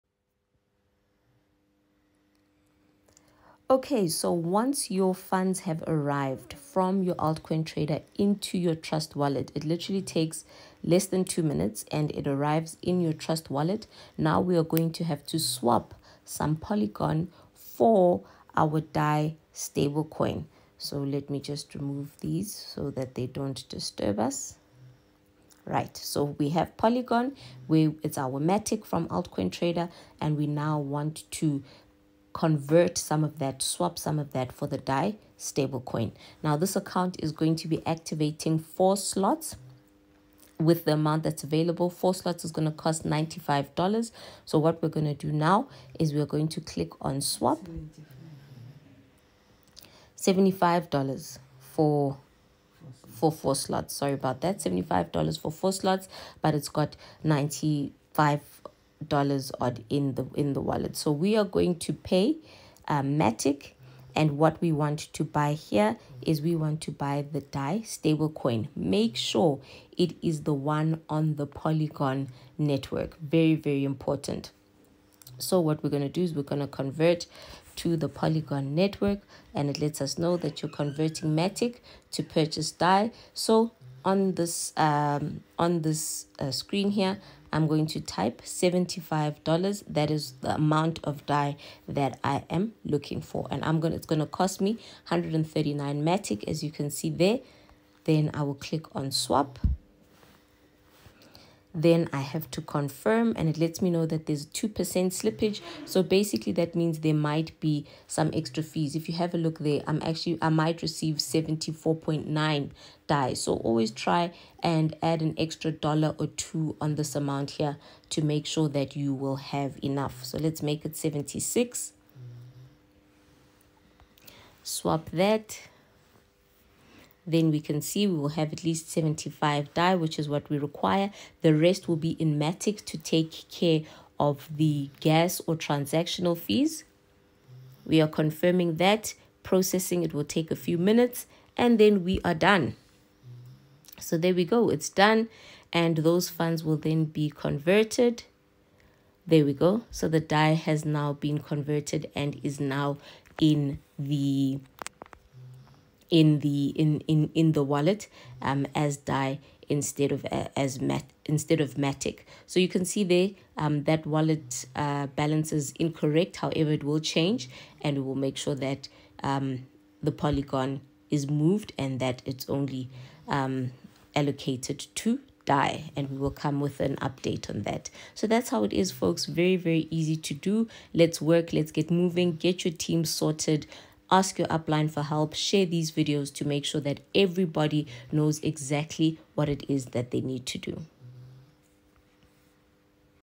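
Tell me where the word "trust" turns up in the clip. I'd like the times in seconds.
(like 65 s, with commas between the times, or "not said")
8 s, 13 s.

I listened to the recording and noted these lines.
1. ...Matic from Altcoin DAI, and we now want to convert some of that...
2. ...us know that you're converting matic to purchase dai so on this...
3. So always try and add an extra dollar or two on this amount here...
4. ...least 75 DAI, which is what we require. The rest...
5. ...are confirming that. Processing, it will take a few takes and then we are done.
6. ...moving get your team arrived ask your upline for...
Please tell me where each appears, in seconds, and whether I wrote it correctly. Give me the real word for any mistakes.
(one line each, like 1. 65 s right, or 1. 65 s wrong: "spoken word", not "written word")
1. 28 s wrong: "Trader", not "DAI"
2. 80 s right
3. 113 s right
4. 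128 s right
5. 138 s wrong: "minutes", not "takes"
6. 181 s wrong: "sorted", not "arrived".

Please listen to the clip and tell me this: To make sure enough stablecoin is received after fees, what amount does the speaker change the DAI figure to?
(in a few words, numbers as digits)
76.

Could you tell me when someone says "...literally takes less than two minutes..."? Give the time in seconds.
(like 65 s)
9 s.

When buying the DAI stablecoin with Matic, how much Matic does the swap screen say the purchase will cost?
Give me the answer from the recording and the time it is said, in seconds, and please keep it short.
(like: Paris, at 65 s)
139 Matic, at 95 s.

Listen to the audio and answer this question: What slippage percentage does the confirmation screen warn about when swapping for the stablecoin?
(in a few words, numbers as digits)
2%.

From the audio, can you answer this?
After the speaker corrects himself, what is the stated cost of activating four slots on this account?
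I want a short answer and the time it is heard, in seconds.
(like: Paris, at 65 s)
$75, at 54 s.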